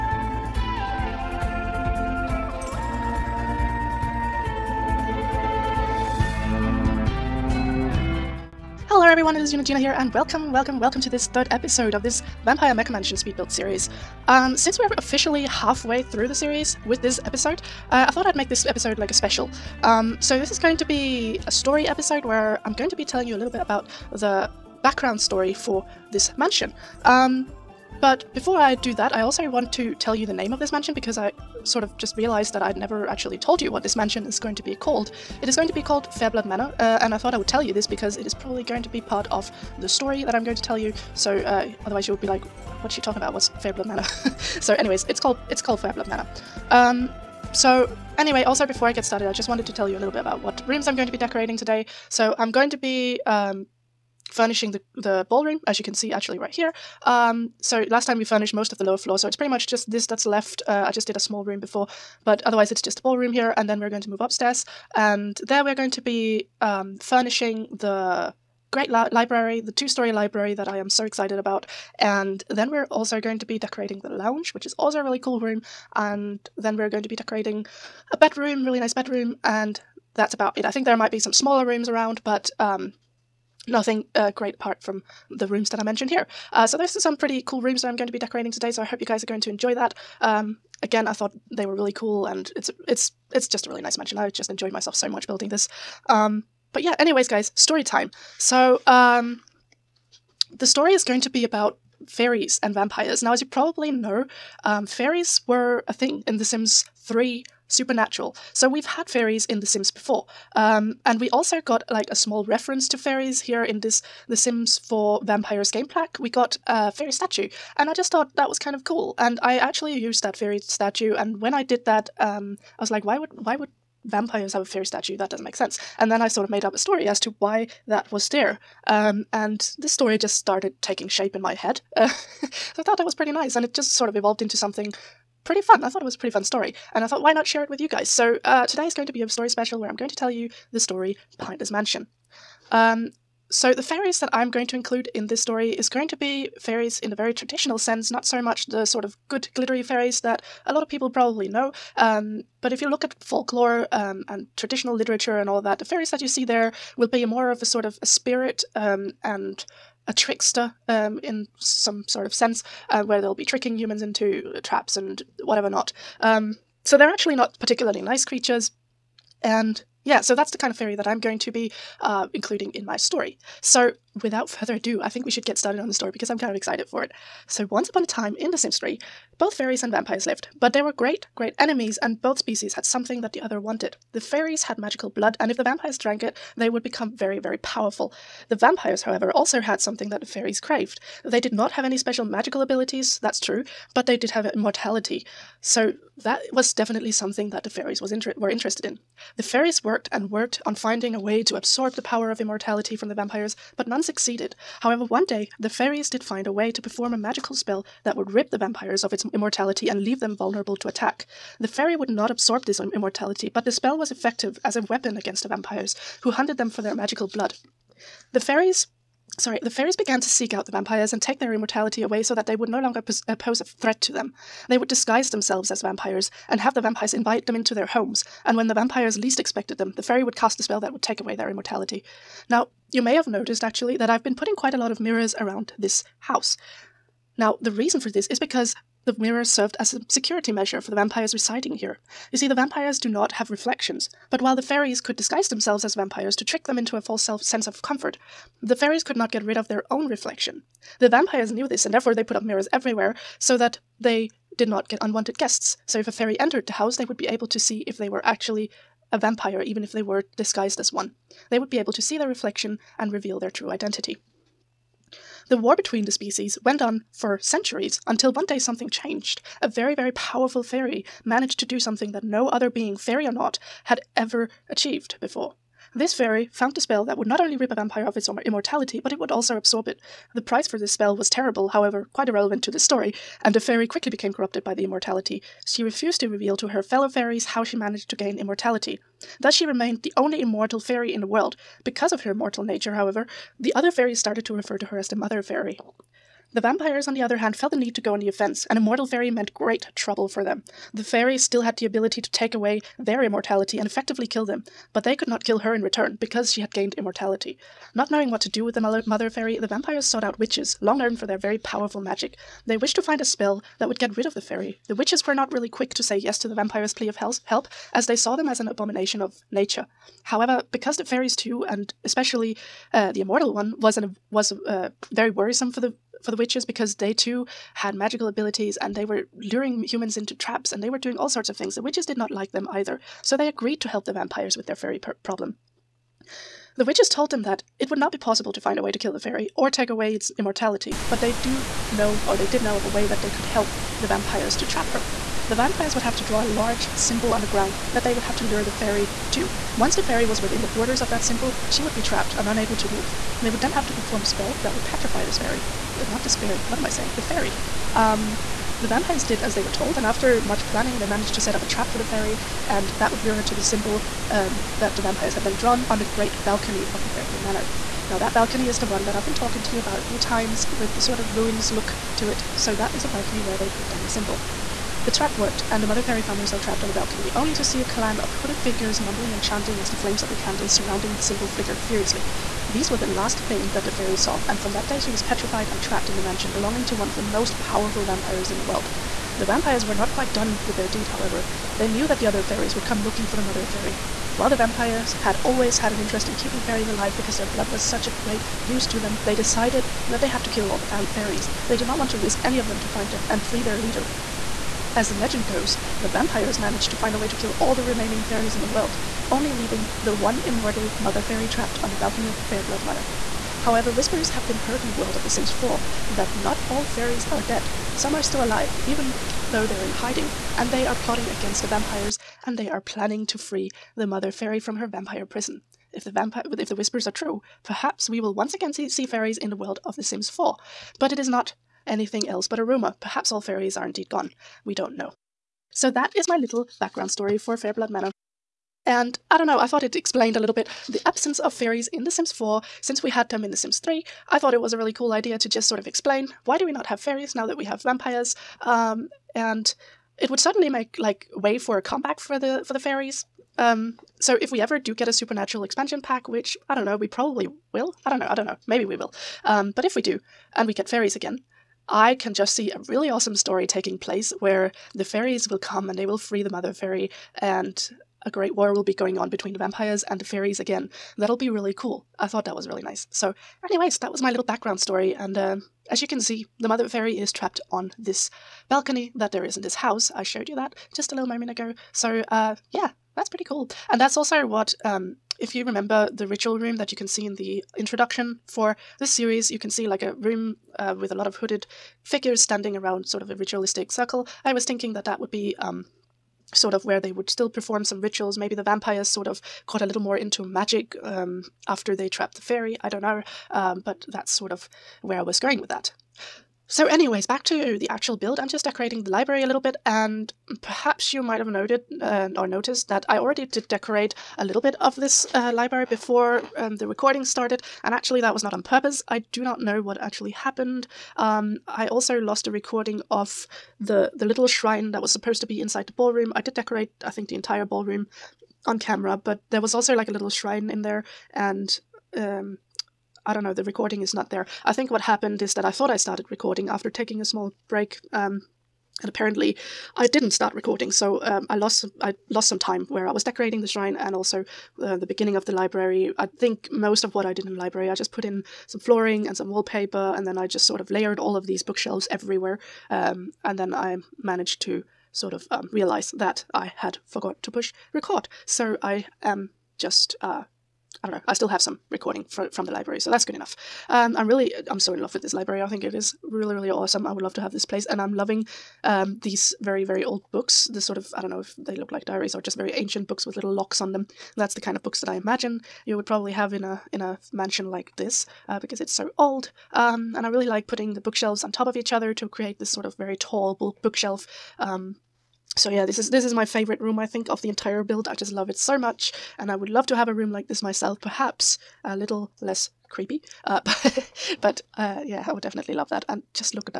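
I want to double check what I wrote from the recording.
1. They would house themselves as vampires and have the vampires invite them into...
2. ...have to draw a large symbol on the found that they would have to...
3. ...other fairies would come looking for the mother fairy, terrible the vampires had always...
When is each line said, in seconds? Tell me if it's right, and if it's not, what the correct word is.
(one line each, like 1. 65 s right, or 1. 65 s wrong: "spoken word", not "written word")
1. 224 s wrong: "disguise", not "house"
2. 346 s wrong: "ground", not "found"
3. 392 s wrong: "while", not "terrible".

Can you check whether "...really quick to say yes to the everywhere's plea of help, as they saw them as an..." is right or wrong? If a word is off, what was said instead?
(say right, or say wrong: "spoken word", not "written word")
wrong: "vampire", not "everywhere".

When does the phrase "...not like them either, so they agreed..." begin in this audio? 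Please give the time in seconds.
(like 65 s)
332 s.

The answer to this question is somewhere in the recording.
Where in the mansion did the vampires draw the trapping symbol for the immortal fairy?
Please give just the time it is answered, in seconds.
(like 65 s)
366 s.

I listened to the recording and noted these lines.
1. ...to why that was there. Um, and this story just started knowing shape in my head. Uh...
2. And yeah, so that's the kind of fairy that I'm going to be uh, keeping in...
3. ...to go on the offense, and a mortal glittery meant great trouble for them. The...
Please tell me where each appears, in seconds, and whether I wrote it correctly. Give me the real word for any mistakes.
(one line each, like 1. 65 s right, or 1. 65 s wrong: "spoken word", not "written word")
1. 127 s wrong: "taking", not "knowing"
2. 169 s wrong: "including", not "keeping"
3. 297 s wrong: "fairy", not "glittery".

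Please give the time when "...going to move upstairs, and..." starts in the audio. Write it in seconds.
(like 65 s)
63 s.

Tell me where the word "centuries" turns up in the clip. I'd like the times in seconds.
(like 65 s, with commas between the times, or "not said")
267 s.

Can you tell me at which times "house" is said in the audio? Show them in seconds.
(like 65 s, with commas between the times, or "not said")
236 s, 256 s, 479 s.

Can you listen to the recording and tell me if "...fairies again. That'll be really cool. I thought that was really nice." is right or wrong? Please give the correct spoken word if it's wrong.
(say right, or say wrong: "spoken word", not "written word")
right.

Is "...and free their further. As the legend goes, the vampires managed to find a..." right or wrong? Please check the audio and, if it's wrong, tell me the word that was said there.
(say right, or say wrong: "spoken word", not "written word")
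wrong: "leader", not "further".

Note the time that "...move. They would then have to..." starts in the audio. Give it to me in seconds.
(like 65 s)
352 s.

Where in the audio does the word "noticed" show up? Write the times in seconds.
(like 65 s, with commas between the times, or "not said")
233 s, 512 s.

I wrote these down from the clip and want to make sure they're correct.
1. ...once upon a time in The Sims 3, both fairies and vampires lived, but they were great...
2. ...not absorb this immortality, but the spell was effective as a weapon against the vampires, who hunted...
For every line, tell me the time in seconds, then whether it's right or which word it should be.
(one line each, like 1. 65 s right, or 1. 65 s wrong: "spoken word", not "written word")
1. 177 s right
2. 212 s right.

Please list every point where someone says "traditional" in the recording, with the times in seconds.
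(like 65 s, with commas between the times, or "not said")
147 s, 154 s.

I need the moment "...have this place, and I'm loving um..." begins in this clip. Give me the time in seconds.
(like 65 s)
567 s.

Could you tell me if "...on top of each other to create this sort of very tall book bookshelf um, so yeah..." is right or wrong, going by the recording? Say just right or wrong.
right.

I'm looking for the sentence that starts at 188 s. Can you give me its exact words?
The vampires, however, also had something that the fairies craved.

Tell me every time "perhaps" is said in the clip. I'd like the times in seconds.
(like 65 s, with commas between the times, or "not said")
427 s, 433 s, 510 s, 591 s.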